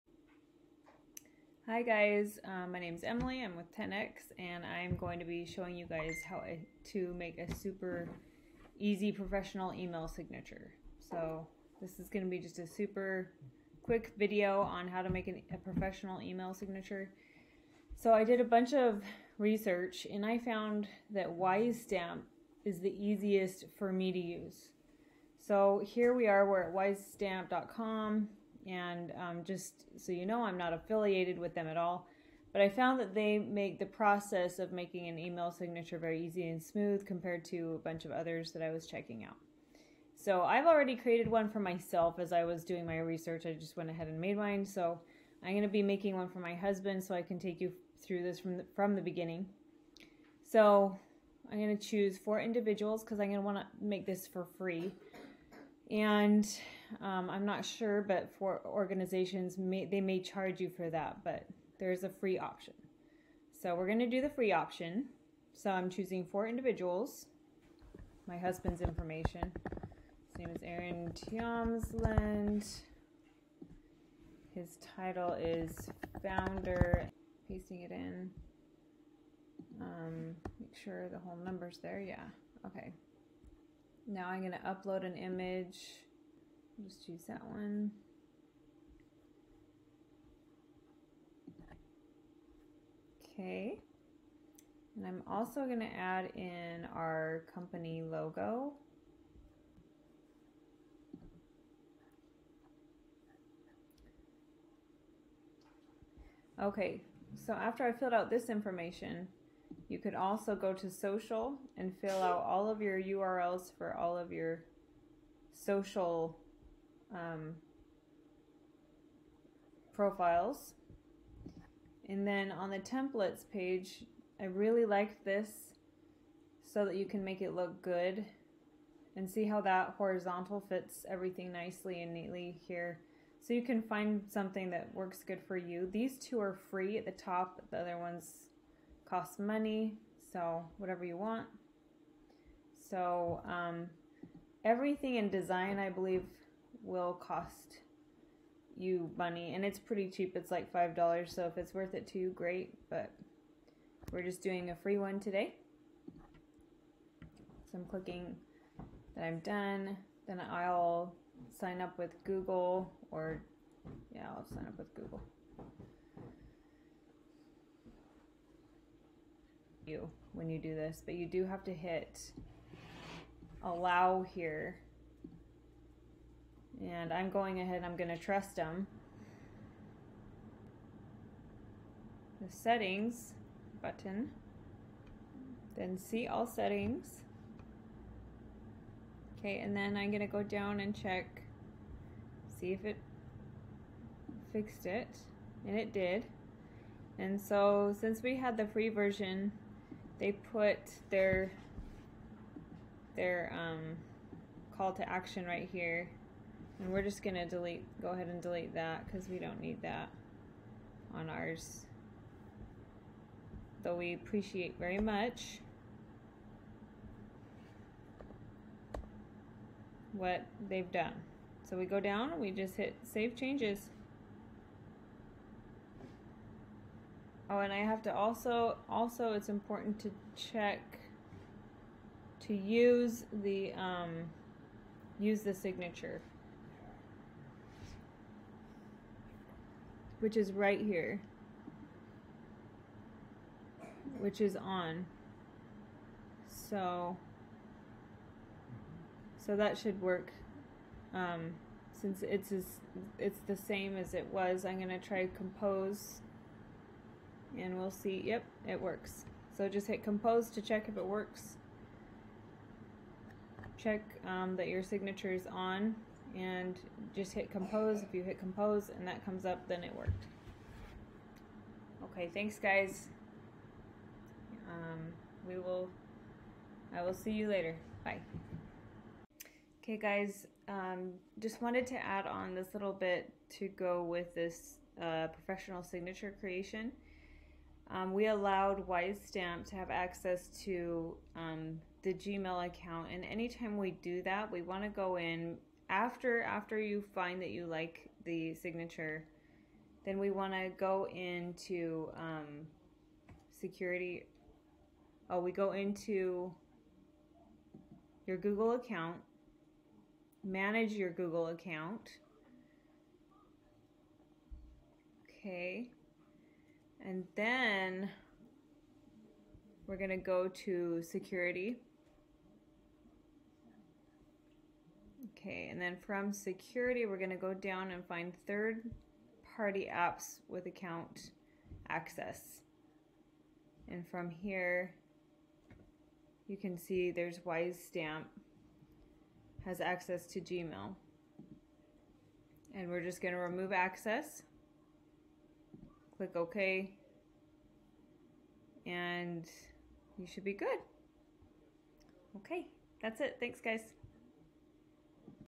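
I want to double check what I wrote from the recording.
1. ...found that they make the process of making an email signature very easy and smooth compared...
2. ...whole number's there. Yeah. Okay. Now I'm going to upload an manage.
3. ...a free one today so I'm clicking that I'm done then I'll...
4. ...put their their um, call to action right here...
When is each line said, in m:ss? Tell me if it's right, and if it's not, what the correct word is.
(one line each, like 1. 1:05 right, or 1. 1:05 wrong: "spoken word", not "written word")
1. 0:32 right
2. 1:21 wrong: "image", not "manage"
3. 2:34 right
4. 3:20 right.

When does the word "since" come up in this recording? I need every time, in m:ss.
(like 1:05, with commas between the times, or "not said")
3:17, 4:11.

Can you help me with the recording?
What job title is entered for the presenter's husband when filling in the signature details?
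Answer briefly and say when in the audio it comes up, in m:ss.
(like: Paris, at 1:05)
founder, at 1:16.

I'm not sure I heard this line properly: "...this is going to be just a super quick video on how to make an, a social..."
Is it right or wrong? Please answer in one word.
wrong.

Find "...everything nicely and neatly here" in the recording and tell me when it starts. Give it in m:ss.
2:11.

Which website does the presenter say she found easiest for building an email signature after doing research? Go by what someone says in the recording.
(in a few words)
Wisestamp.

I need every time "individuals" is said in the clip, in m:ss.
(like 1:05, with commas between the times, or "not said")
0:52, 1:06.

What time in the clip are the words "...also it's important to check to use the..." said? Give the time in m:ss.
3:48.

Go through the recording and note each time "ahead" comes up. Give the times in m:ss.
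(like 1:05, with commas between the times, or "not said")
0:43, 2:57, 3:28.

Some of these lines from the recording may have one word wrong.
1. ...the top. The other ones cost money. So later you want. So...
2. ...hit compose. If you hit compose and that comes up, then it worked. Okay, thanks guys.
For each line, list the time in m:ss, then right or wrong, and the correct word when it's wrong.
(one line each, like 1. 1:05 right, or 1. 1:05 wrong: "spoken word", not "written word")
1. 2:17 wrong: "whatever", not "later"
2. 4:27 right.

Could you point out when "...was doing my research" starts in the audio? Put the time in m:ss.
0:42.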